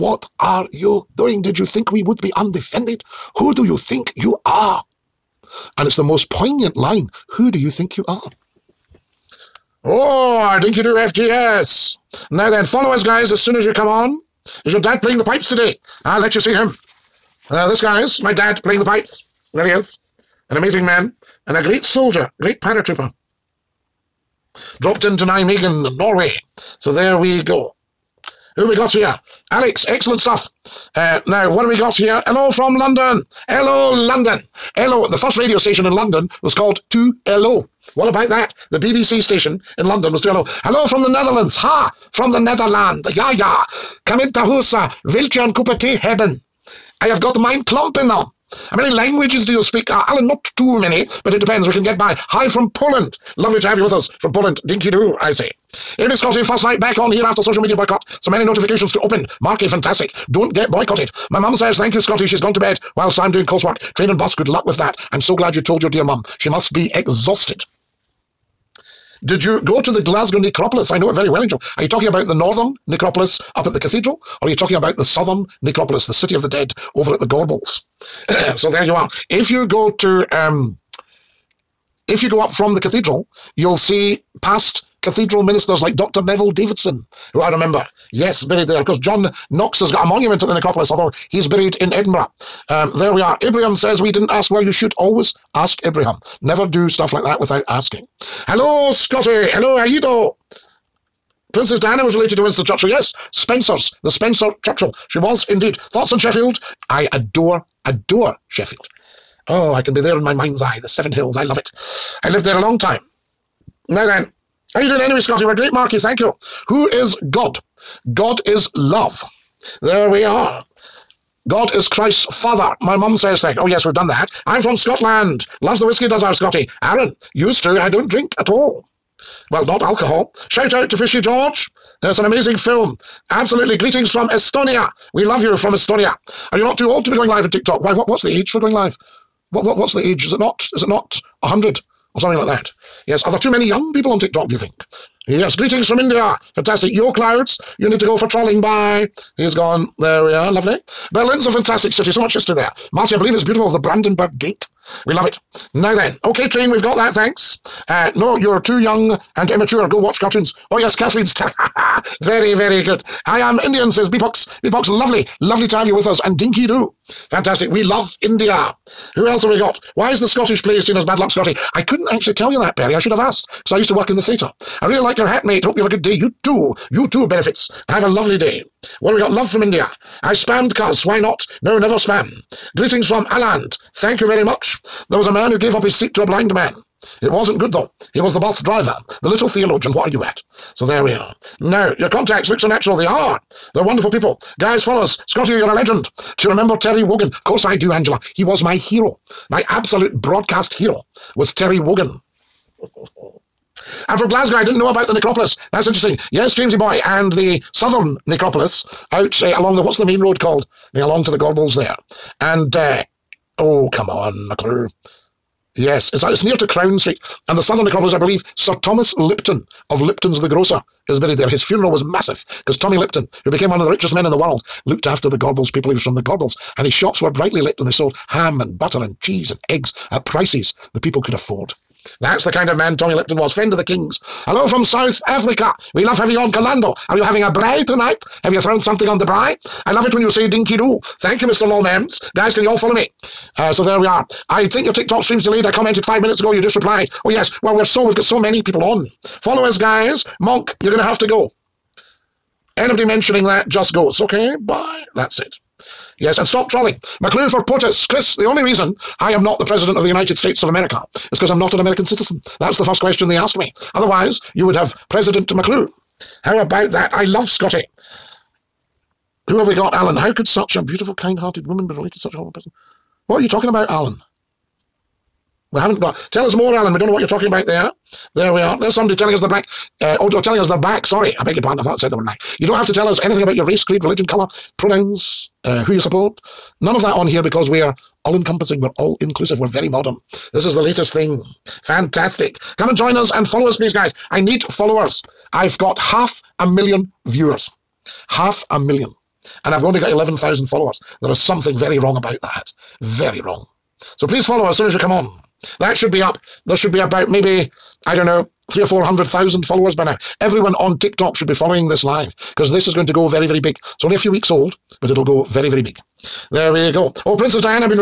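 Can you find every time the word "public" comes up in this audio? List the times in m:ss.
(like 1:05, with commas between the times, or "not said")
not said.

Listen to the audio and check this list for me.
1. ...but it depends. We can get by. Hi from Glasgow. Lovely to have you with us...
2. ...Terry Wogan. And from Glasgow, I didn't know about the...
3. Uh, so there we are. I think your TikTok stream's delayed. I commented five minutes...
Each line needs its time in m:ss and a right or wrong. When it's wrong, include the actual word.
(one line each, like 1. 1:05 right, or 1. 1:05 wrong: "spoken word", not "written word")
1. 0:51 wrong: "Poland", not "Glasgow"
2. 3:21 right
3. 4:03 right.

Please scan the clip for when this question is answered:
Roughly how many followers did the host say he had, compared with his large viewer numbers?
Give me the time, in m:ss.
5:00.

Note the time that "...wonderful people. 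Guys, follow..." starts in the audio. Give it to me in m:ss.
3:13.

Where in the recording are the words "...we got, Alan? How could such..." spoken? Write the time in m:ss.
4:29.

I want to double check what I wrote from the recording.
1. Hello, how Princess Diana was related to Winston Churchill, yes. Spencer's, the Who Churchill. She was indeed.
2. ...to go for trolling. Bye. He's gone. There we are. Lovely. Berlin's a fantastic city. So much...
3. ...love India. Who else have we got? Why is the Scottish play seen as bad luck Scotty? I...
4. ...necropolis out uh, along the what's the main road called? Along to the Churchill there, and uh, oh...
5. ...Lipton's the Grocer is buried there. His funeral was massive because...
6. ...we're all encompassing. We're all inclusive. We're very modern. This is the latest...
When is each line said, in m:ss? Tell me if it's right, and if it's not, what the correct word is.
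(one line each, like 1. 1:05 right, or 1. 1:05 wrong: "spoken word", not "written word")
1. 1:39 wrong: "Spencer", not "Who"
2. 2:27 right
3. 2:47 right
4. 3:28 wrong: "Gorbals", not "Churchill"
5. 3:40 right
6. 4:47 right.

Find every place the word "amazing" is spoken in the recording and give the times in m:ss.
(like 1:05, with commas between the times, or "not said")
0:20, 2:12.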